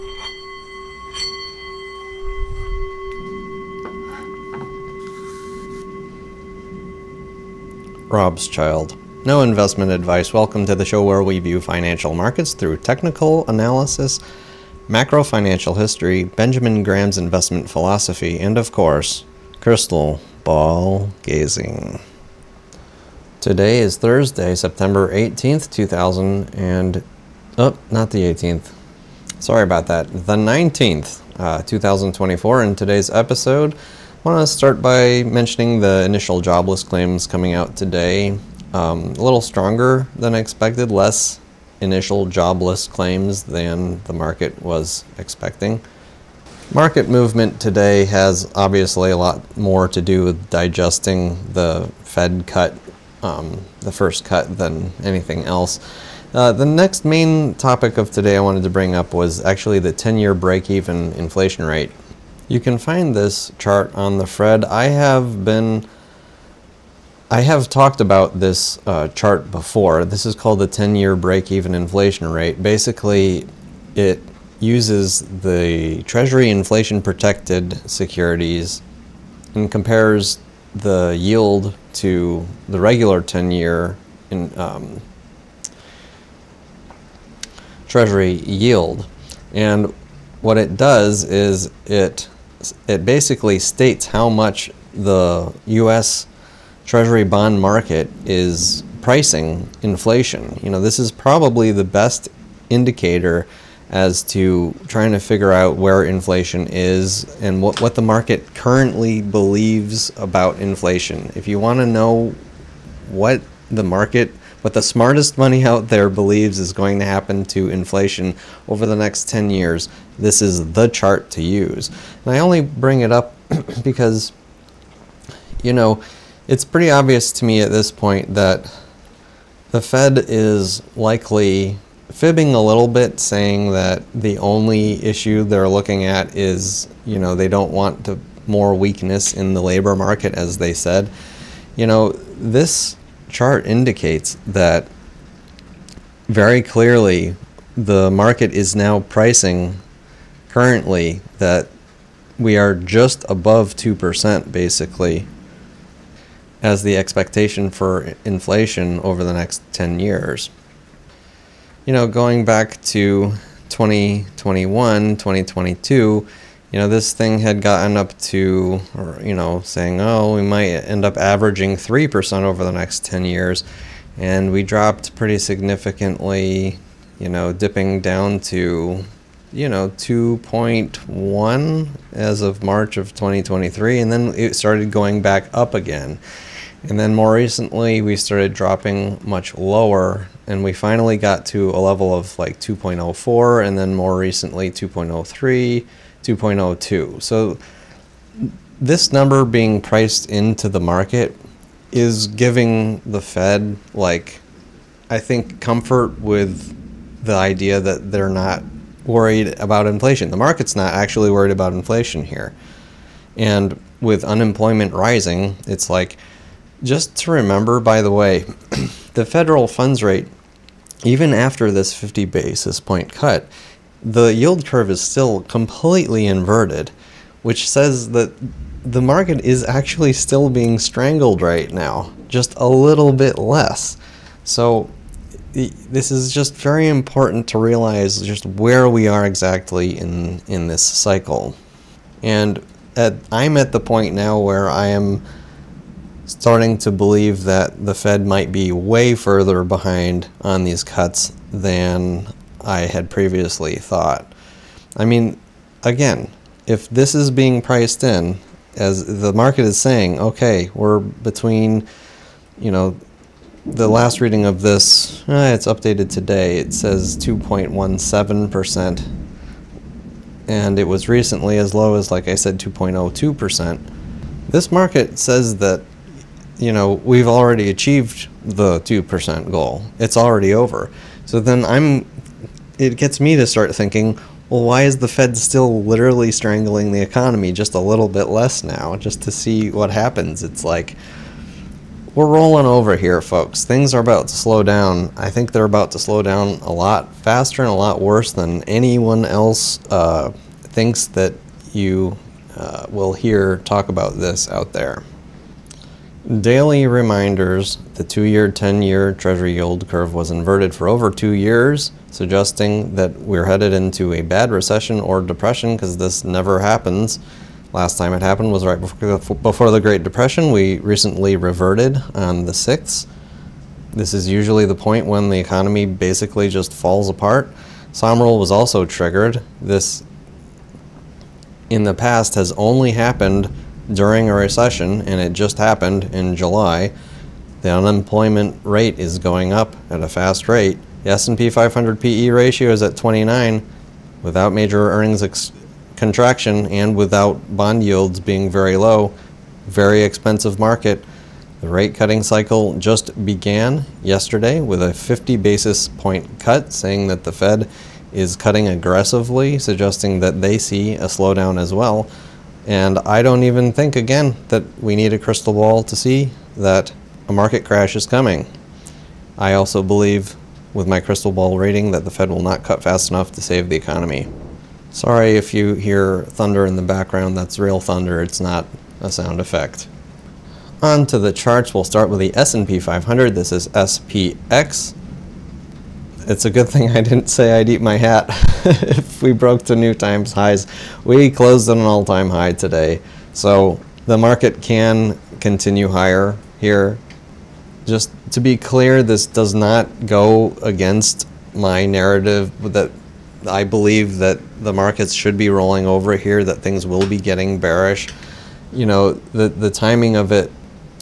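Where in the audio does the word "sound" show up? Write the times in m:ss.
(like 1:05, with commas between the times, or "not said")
6:19.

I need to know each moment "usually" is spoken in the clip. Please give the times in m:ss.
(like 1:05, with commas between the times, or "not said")
5:24.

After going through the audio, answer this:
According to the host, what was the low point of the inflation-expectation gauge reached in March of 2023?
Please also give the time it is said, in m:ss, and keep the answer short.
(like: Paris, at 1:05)
2.1, at 2:59.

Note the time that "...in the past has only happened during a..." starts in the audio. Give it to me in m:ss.
5:31.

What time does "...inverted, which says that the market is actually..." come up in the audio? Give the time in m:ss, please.
3:46.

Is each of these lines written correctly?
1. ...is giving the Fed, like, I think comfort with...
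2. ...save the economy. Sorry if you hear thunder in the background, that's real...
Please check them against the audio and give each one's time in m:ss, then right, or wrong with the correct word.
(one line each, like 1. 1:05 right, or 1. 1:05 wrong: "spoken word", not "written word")
1. 3:21 right
2. 6:13 right.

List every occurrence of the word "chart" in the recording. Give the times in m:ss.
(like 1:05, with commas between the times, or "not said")
1:03, 1:09, 2:00, 2:23, 6:21.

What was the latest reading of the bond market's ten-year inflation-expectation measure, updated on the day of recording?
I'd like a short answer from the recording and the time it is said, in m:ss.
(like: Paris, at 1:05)
2.17%, at 4:27.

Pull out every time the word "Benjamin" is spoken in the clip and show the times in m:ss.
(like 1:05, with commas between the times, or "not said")
0:16.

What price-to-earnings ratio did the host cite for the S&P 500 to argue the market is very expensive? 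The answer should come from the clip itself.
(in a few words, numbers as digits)
29.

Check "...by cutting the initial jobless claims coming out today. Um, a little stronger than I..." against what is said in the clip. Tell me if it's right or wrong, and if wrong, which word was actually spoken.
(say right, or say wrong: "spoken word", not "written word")
wrong: "mentioning", not "cutting".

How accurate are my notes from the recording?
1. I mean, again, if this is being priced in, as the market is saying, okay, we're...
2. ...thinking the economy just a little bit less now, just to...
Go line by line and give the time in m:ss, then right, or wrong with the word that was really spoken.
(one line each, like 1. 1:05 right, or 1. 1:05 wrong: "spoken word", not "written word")
1. 4:14 right
2. 4:46 wrong: "strangling", not "thinking".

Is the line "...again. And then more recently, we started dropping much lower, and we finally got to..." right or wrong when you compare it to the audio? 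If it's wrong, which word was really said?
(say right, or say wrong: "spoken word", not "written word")
right.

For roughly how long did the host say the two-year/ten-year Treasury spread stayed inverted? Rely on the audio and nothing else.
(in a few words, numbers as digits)
over two years.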